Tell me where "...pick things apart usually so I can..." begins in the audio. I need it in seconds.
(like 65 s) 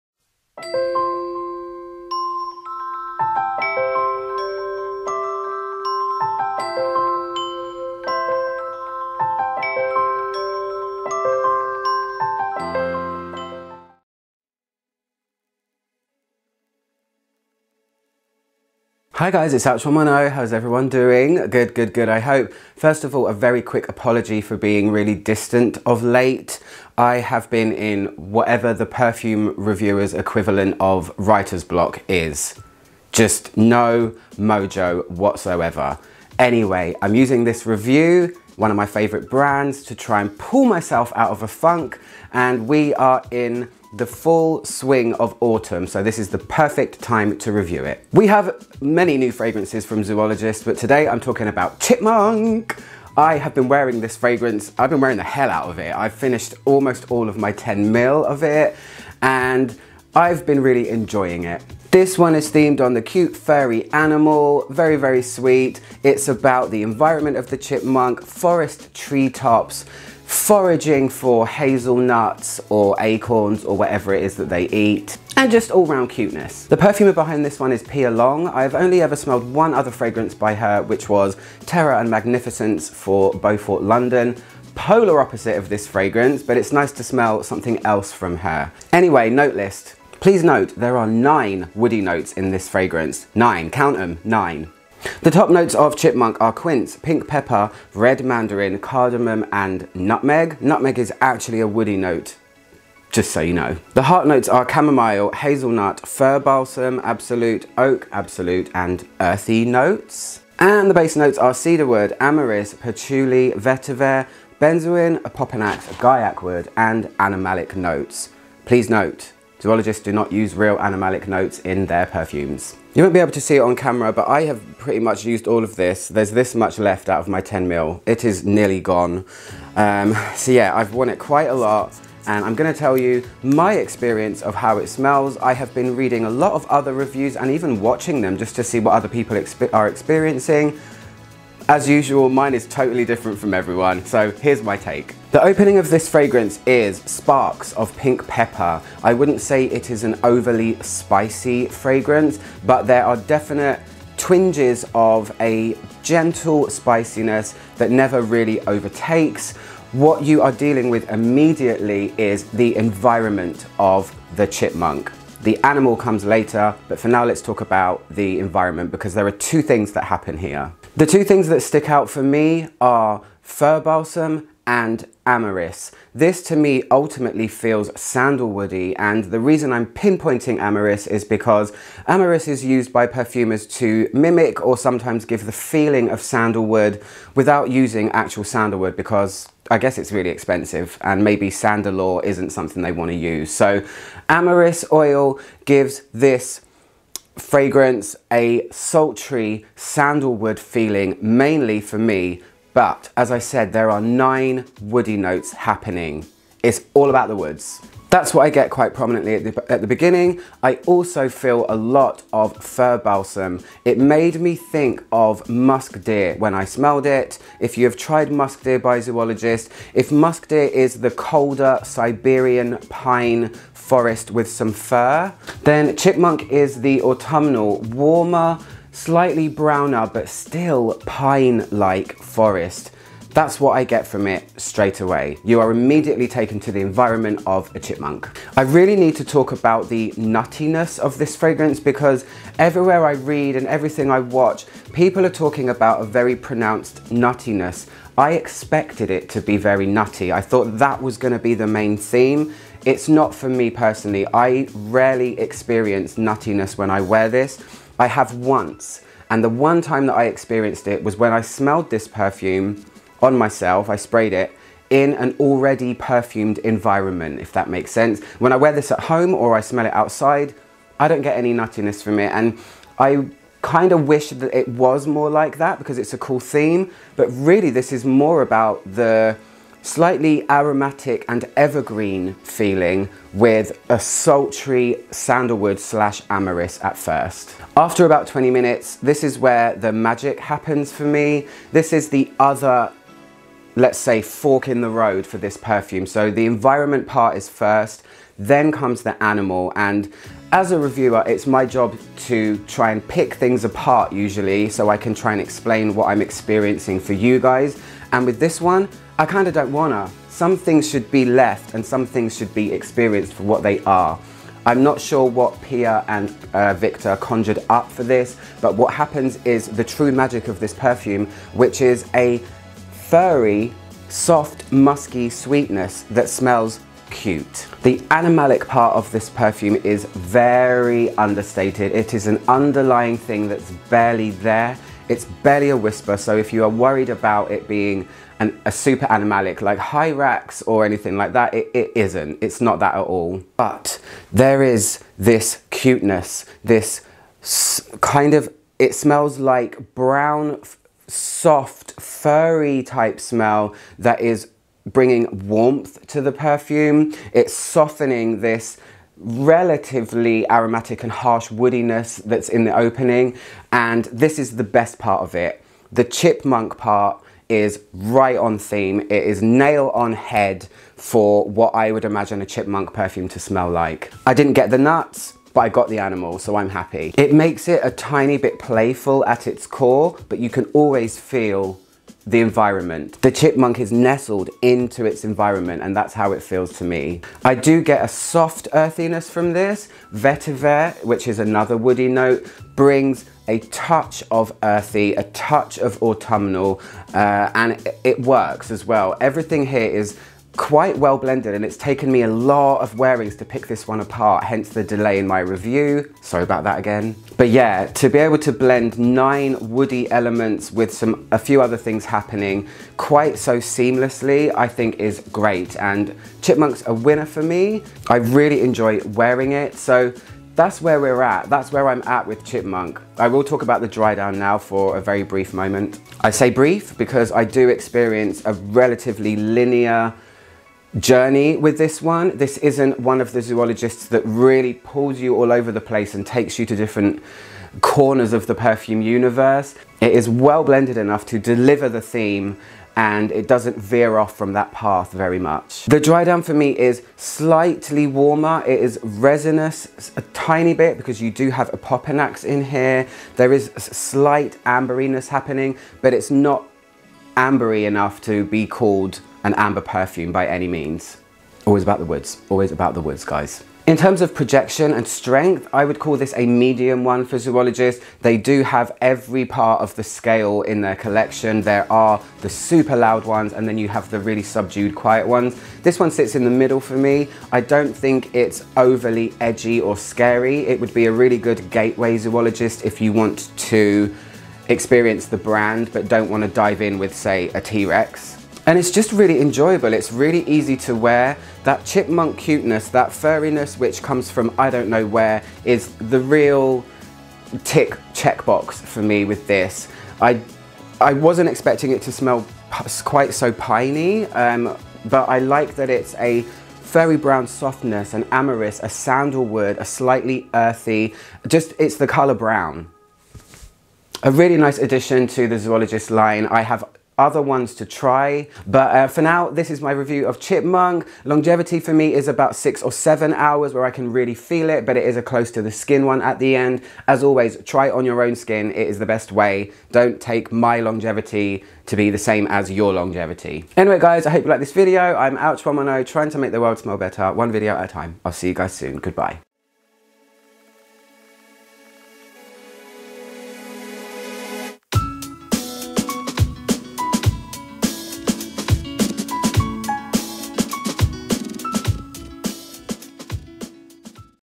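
303 s.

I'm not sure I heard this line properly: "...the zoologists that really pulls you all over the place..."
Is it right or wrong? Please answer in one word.
right.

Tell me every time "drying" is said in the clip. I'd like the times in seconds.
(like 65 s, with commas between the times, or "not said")
not said.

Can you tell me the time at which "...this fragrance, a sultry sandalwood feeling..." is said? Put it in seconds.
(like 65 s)
196 s.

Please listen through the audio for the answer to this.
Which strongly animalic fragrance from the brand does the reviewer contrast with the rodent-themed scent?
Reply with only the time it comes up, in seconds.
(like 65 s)
339 s.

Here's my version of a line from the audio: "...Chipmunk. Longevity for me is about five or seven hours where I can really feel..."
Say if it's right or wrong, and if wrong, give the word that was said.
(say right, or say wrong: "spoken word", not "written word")
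wrong: "six", not "five".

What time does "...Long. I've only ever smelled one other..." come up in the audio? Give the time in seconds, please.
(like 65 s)
78 s.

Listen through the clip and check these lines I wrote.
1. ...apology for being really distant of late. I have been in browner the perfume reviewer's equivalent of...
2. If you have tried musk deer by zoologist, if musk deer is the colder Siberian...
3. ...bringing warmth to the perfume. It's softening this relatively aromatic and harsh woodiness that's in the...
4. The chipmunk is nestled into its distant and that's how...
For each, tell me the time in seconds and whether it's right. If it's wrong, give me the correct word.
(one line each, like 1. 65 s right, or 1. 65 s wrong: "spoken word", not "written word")
1. 23 s wrong: "whatever", not "browner"
2. 217 s right
3. 354 s right
4. 383 s wrong: "environment", not "distant".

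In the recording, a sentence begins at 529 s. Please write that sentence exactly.
Don't take my longevity to be the same as your longevity.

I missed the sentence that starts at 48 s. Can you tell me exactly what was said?
We have many new fragrances from Zoologist, but today I'm talking about Chipmunk.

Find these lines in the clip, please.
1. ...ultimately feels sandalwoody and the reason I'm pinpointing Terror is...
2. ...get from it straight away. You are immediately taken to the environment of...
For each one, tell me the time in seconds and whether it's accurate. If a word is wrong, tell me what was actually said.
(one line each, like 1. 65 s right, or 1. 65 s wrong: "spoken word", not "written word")
1. 176 s wrong: "Amyris", not "Terror"
2. 233 s right.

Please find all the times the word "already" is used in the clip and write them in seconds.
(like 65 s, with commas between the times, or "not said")
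265 s.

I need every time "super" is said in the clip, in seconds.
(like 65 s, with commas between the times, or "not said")
338 s, 472 s.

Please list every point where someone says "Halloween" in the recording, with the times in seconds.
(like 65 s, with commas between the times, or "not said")
not said.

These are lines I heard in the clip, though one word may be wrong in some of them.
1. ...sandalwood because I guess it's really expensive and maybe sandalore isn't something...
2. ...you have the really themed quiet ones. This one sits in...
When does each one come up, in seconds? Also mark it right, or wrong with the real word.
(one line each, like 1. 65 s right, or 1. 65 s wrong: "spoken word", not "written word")
1. 188 s right
2. 473 s wrong: "subdued", not "themed".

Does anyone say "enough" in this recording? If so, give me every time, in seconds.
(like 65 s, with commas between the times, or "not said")
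440 s, 457 s.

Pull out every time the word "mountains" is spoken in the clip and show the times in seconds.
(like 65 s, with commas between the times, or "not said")
not said.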